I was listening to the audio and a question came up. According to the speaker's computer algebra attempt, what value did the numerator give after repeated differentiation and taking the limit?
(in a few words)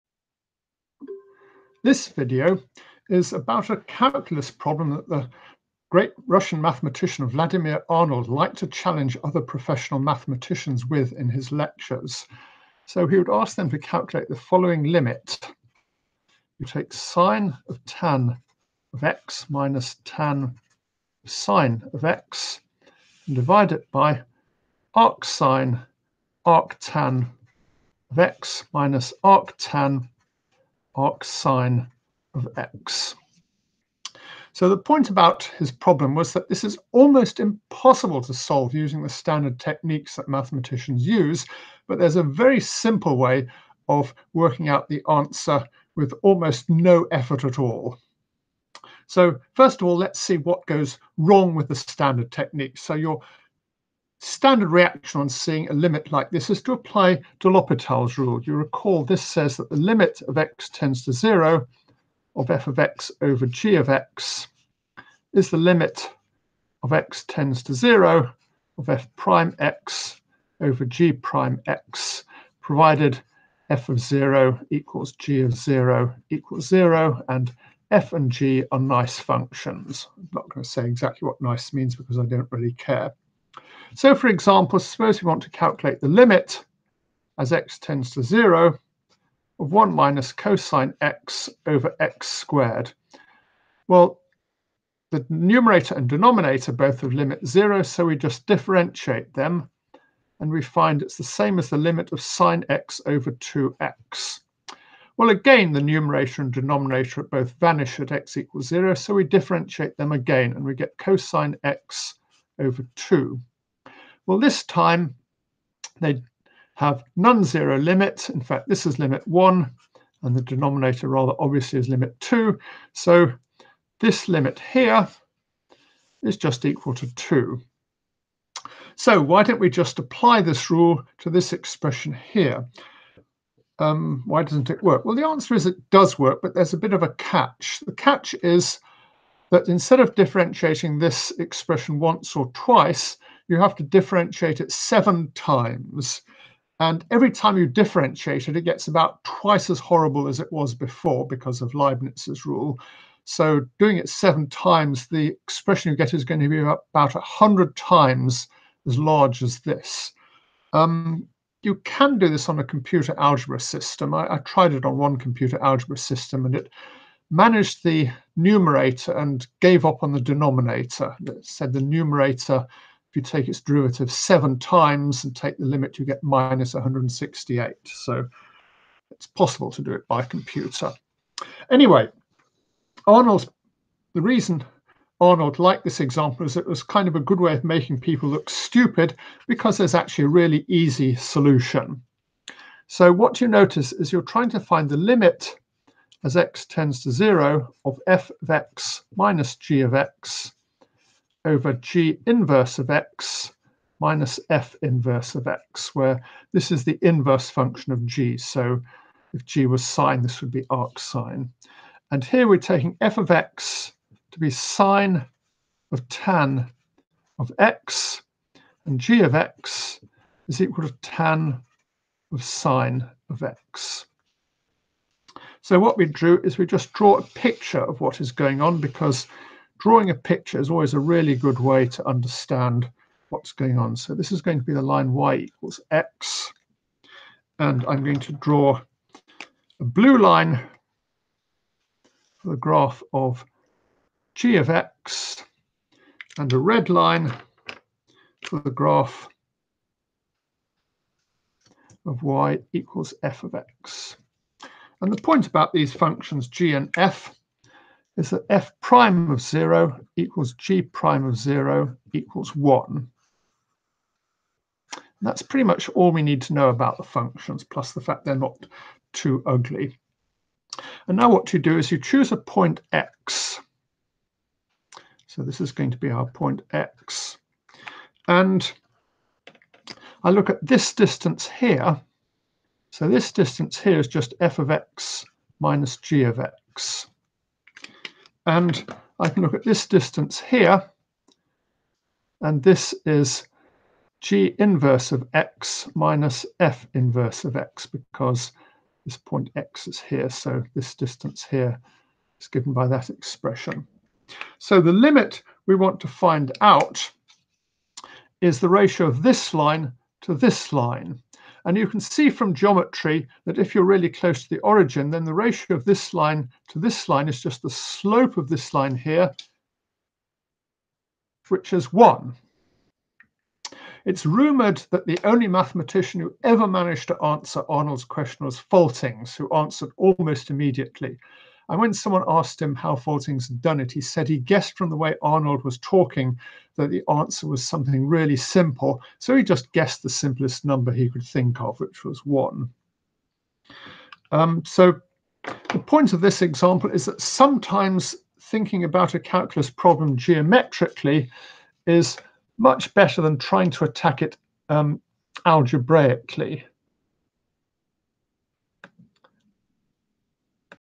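-168.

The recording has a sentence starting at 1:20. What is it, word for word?
I'm not going to say exactly what nice means because I don't really care.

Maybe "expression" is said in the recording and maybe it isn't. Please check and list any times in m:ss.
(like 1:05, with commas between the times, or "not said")
2:11, 2:21, 2:35, 5:03.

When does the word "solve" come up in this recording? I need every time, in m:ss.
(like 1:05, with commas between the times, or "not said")
0:38.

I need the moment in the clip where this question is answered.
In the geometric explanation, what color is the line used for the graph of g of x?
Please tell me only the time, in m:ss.
3:59.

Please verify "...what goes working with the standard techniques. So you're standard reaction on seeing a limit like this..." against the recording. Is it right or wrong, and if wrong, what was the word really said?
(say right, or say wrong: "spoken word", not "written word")
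wrong: "wrong", not "working".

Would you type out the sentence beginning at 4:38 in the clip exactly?
And I look at this distance here.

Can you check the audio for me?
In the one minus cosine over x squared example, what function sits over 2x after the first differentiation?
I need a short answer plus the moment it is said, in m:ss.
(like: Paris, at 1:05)
sine x, at 1:42.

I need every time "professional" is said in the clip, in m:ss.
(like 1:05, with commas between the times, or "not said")
0:09.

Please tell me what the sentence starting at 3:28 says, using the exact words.
So if g was sine, this would be arc sine.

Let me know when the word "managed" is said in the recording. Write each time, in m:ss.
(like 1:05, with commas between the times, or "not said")
2:47, 5:26.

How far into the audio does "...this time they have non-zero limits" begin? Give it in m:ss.
1:54.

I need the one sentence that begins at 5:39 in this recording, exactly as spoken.
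So he just guessed the simplest number he could think of, which was one.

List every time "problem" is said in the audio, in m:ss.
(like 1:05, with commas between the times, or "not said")
0:04, 0:35, 5:49.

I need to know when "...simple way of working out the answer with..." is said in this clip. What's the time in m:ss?
0:42.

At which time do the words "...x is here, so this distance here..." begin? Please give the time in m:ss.
4:59.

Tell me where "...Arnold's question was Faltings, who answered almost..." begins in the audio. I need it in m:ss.
5:27.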